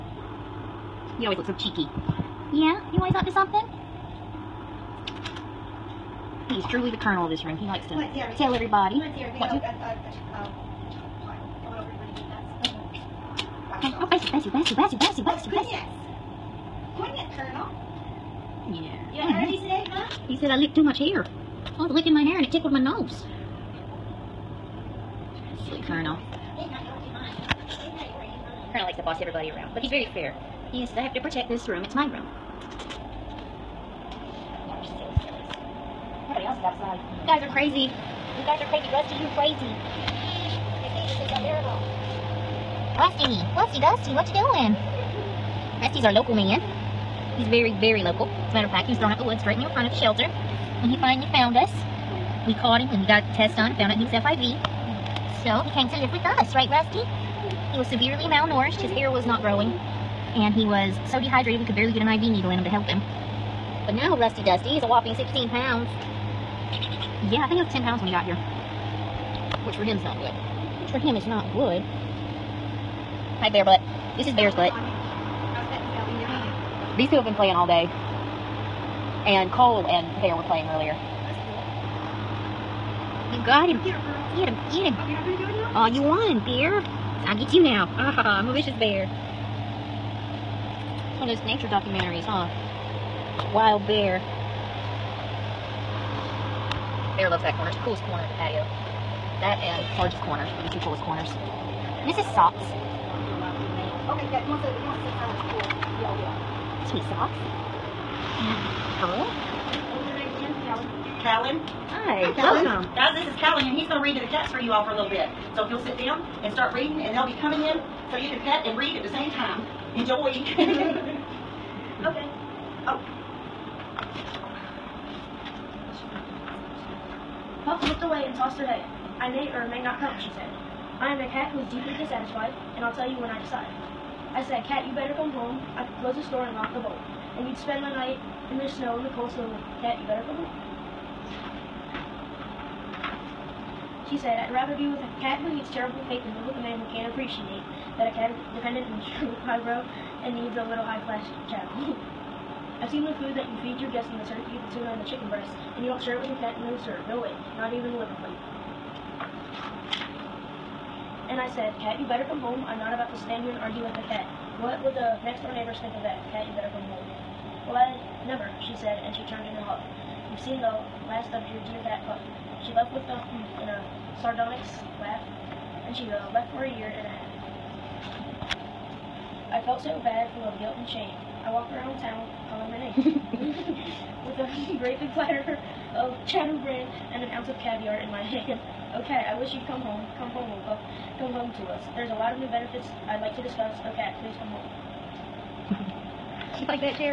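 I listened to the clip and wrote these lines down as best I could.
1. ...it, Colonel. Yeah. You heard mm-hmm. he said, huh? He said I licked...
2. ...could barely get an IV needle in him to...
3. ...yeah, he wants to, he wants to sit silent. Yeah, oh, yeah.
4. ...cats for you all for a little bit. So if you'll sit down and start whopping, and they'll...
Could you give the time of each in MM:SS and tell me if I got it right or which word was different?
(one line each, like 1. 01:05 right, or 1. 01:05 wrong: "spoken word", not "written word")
1. 00:16 right
2. 01:01 right
3. 01:44 right
4. 01:54 wrong: "reading", not "whopping".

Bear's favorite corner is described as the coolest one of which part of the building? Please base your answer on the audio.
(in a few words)
The patio.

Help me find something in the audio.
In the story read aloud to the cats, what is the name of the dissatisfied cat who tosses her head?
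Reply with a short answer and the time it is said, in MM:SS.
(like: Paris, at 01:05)
Puff, at 02:07.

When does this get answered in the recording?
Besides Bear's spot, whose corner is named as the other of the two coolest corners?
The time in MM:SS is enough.
01:39.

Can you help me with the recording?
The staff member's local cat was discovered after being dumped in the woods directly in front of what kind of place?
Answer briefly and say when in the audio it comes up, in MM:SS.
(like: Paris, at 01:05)
The shelter, at 00:49.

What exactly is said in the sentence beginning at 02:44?
What would the next door neighbors think of that?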